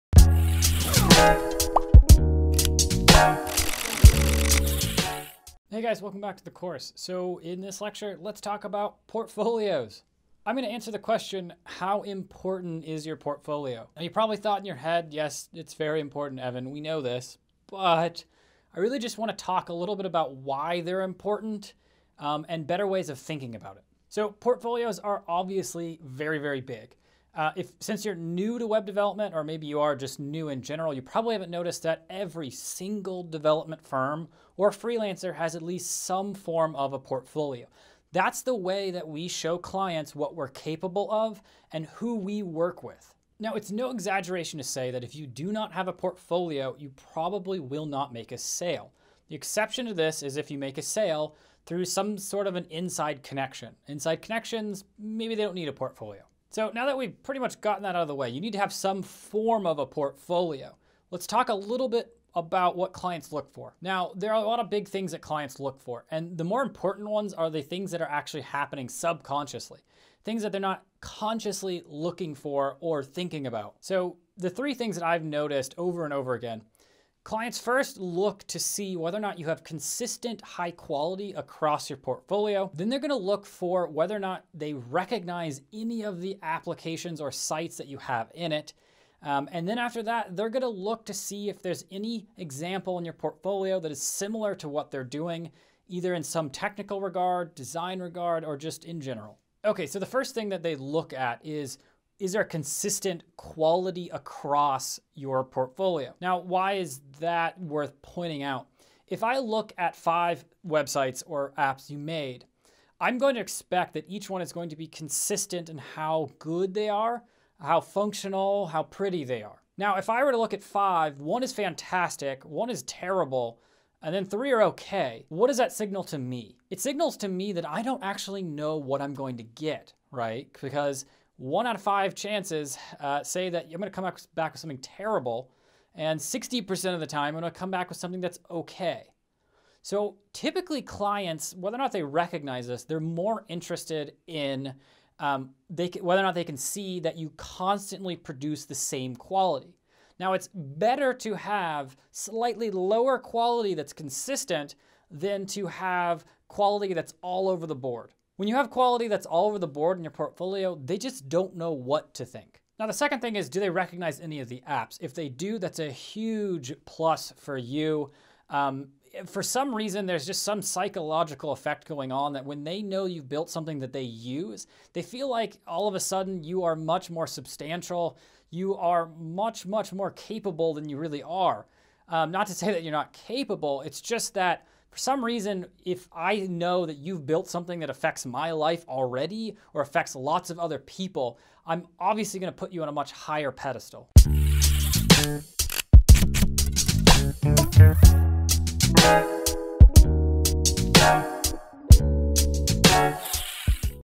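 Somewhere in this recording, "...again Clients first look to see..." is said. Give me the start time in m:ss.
1:16.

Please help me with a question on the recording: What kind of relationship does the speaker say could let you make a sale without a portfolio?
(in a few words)
inside connection.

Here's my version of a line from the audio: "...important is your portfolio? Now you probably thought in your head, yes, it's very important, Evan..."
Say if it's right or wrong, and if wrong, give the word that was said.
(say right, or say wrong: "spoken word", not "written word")
right.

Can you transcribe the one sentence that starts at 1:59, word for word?
Now, if I were to look at five, one is fantastic, one is terrible, and then three are okay.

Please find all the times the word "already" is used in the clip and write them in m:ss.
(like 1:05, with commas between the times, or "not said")
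3:08.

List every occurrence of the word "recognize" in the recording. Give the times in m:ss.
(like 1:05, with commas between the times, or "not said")
1:24, 2:22, 2:43.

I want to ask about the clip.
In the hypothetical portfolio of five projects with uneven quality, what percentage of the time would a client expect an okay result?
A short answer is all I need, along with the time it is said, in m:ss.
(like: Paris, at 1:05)
60%, at 2:16.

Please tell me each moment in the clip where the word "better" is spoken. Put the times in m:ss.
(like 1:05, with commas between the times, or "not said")
0:22, 2:30.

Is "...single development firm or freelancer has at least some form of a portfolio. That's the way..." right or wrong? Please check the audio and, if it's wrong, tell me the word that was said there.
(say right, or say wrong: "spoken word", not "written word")
right.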